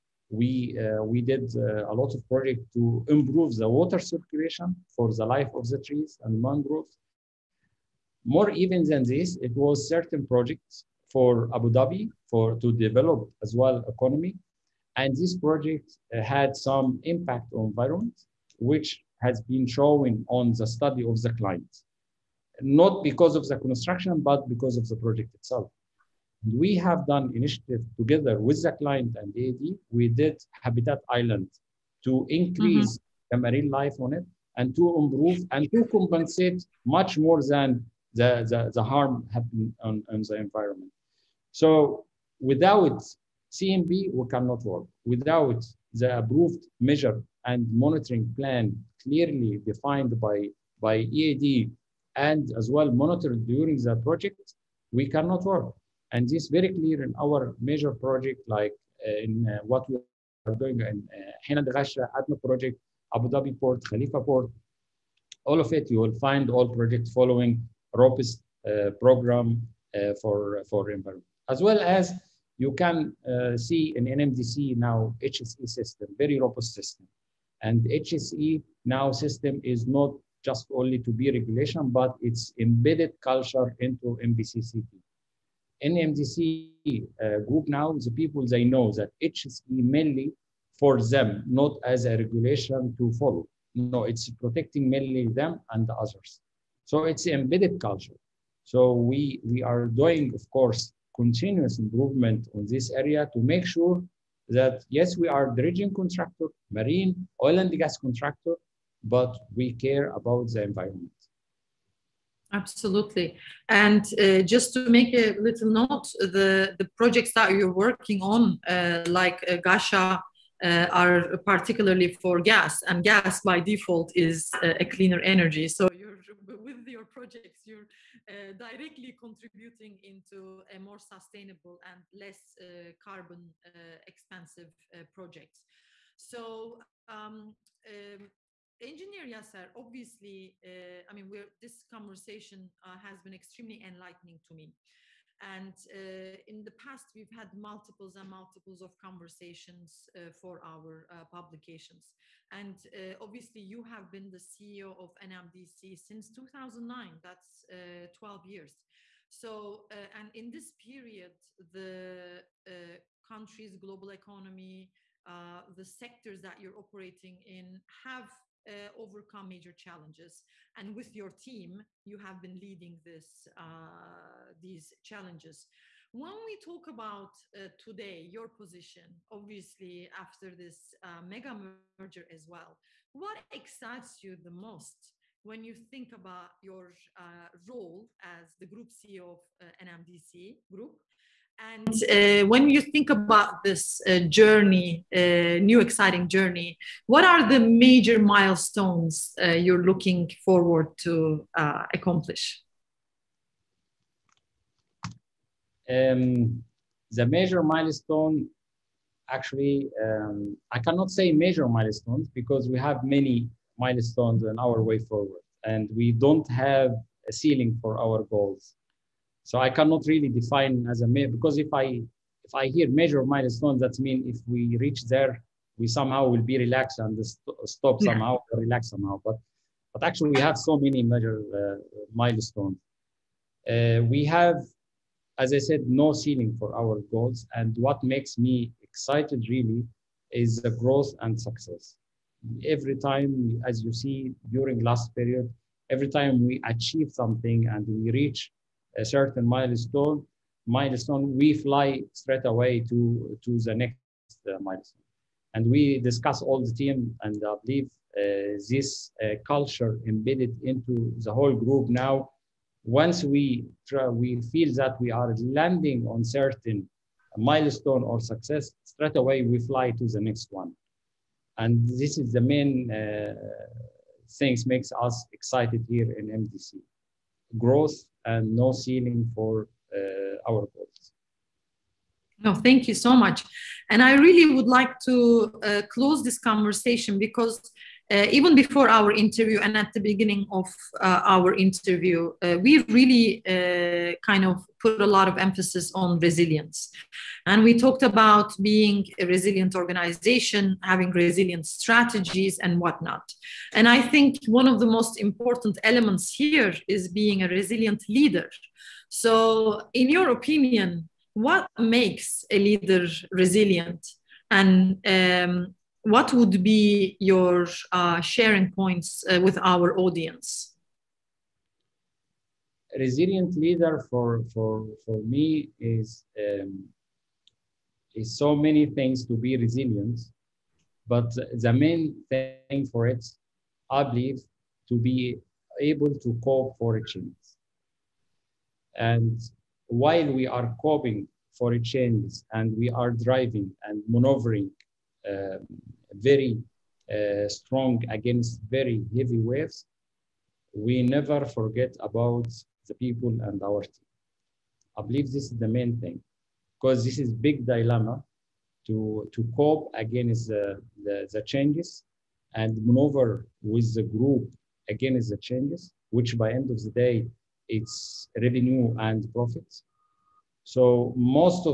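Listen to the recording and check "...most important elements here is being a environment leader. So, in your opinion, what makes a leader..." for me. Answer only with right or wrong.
wrong.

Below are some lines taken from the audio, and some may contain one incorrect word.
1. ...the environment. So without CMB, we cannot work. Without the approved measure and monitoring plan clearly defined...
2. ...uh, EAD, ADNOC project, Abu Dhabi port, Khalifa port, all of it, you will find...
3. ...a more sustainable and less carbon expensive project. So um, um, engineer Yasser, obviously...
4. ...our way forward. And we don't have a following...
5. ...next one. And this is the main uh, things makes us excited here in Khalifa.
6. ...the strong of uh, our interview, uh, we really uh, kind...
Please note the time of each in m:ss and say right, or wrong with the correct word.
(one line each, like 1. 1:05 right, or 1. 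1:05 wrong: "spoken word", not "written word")
1. 0:40 right
2. 1:01 wrong: "Ghasha", not "EAD"
3. 2:10 right
4. 3:34 wrong: "ceiling", not "following"
5. 4:30 wrong: "MDC", not "Khalifa"
6. 4:49 wrong: "beginning", not "strong".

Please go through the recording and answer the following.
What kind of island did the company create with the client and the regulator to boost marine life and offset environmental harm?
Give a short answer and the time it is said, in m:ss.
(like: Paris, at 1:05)
Habitat Island, at 0:30.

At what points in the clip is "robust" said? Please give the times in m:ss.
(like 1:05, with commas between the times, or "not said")
1:07, 1:16.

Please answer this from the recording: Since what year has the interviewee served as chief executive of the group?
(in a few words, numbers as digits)
2009.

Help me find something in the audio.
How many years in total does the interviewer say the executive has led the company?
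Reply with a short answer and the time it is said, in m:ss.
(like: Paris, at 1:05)
12 years, at 2:37.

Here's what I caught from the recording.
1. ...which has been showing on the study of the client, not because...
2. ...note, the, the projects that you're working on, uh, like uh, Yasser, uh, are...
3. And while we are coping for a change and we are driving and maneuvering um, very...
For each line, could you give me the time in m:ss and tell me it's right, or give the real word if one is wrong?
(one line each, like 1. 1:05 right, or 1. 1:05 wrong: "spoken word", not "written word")
1. 0:18 right
2. 1:55 wrong: "Ghasha", not "Yasser"
3. 5:38 right.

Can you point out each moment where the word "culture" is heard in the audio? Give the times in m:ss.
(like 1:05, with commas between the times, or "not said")
1:23, 1:37, 4:19.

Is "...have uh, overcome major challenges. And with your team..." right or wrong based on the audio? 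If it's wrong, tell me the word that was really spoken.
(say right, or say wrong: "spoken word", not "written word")
right.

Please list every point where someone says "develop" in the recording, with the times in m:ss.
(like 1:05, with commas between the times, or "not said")
0:12.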